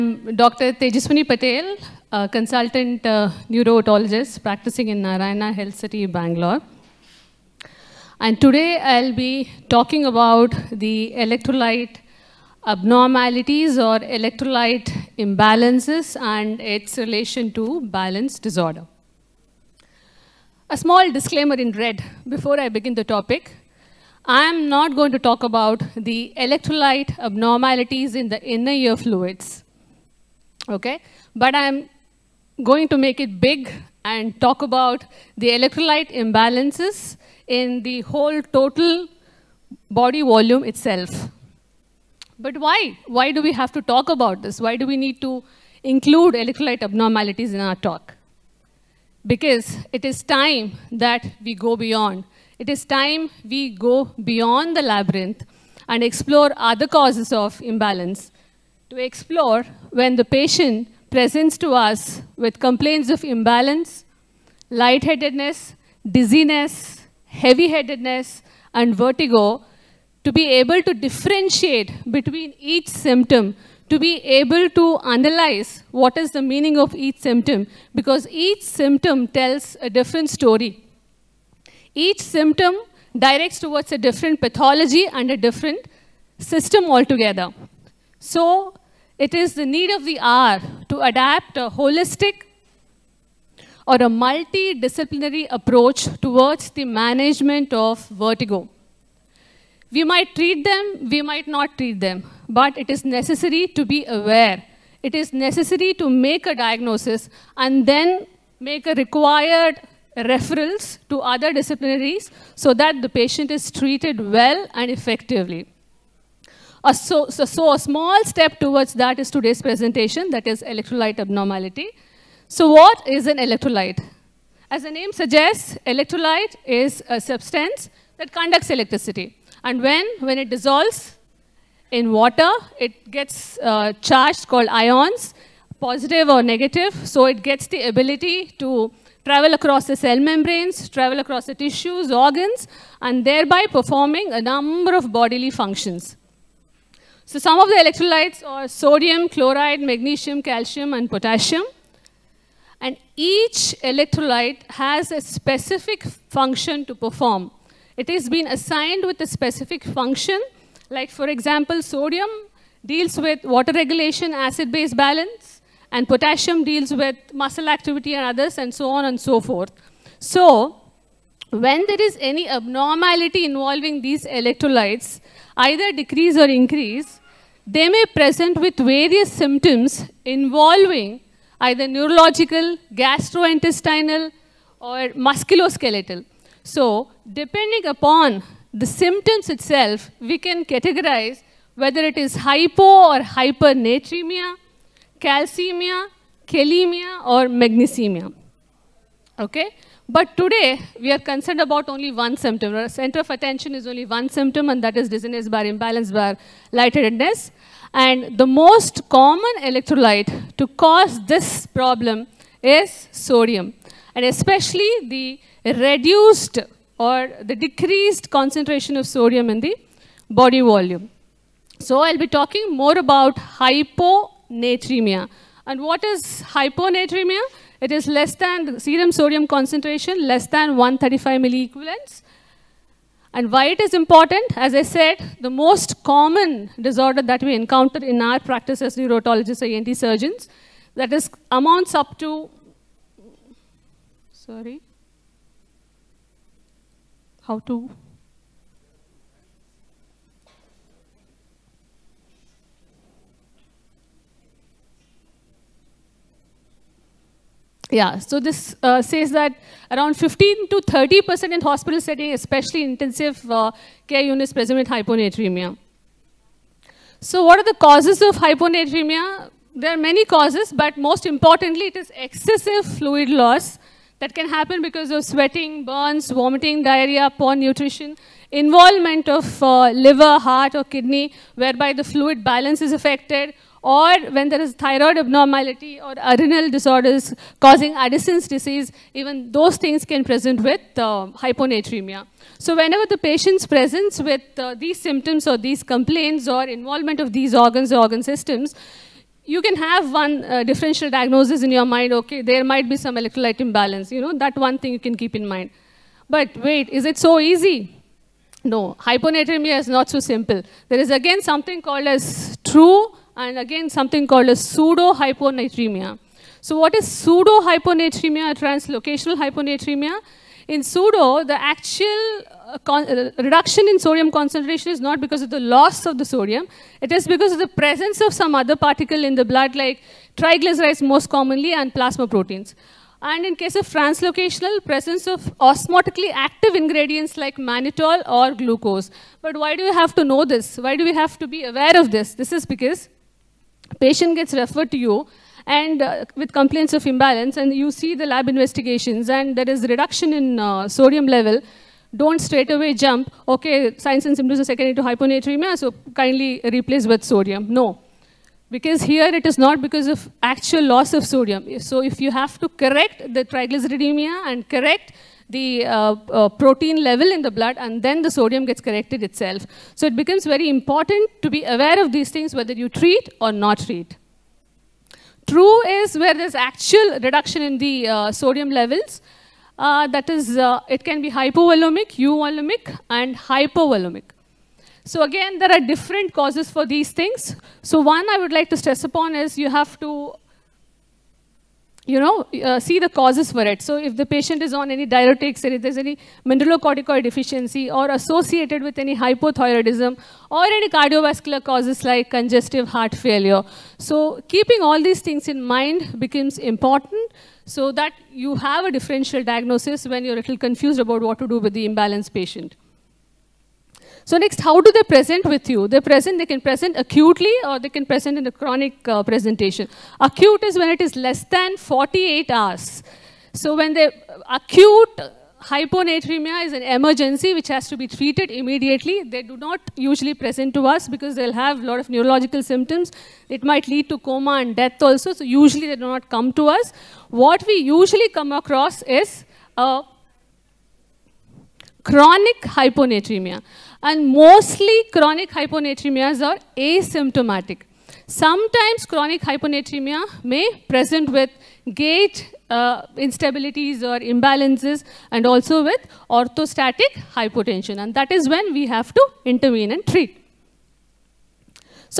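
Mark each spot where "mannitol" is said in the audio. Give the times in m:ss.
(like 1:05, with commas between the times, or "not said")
5:37.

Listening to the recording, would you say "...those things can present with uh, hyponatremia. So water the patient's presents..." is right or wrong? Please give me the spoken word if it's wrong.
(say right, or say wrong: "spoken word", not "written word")
wrong: "whenever", not "water".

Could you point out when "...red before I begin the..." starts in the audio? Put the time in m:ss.
0:21.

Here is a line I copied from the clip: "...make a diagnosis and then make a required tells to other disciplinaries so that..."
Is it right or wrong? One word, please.
wrong.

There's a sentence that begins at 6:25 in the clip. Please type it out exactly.
So again, there are different causes for these things.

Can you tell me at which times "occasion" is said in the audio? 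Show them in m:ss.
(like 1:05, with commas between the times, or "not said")
not said.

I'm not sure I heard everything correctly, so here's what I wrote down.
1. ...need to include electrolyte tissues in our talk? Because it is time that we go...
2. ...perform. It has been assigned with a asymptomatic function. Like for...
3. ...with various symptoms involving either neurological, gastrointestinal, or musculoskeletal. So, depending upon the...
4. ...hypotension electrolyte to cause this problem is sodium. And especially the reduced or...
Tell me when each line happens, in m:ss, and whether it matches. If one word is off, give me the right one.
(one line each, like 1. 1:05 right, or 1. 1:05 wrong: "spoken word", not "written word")
1. 0:44 wrong: "abnormalities", not "tissues"
2. 2:36 wrong: "specific", not "asymptomatic"
3. 2:58 right
4. 3:29 wrong: "common", not "hypotension".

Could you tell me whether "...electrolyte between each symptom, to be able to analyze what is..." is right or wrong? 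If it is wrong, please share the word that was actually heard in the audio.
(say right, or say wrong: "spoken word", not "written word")
wrong: "differentiate", not "electrolyte".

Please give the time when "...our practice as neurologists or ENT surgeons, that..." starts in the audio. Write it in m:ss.
3:58.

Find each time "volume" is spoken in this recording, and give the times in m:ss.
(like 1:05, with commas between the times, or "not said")
0:40, 3:40.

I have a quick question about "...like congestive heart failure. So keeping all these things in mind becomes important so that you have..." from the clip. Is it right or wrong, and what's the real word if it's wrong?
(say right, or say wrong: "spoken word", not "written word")
right.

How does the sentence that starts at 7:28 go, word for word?
Sometimes chronic hyponatremia may present with gait uh, instabilities or imbalances and also with orthostatic hypotension.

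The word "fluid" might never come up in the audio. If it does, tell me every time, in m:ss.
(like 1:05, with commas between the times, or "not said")
0:28, 4:32, 4:42.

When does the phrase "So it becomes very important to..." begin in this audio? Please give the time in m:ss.
6:09.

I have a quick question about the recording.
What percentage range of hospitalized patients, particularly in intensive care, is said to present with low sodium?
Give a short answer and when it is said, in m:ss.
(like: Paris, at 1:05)
15 to 30%, at 4:20.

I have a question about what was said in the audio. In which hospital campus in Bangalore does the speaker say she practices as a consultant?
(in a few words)
Narayana Health City.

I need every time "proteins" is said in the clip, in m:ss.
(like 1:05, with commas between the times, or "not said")
5:32, 6:06.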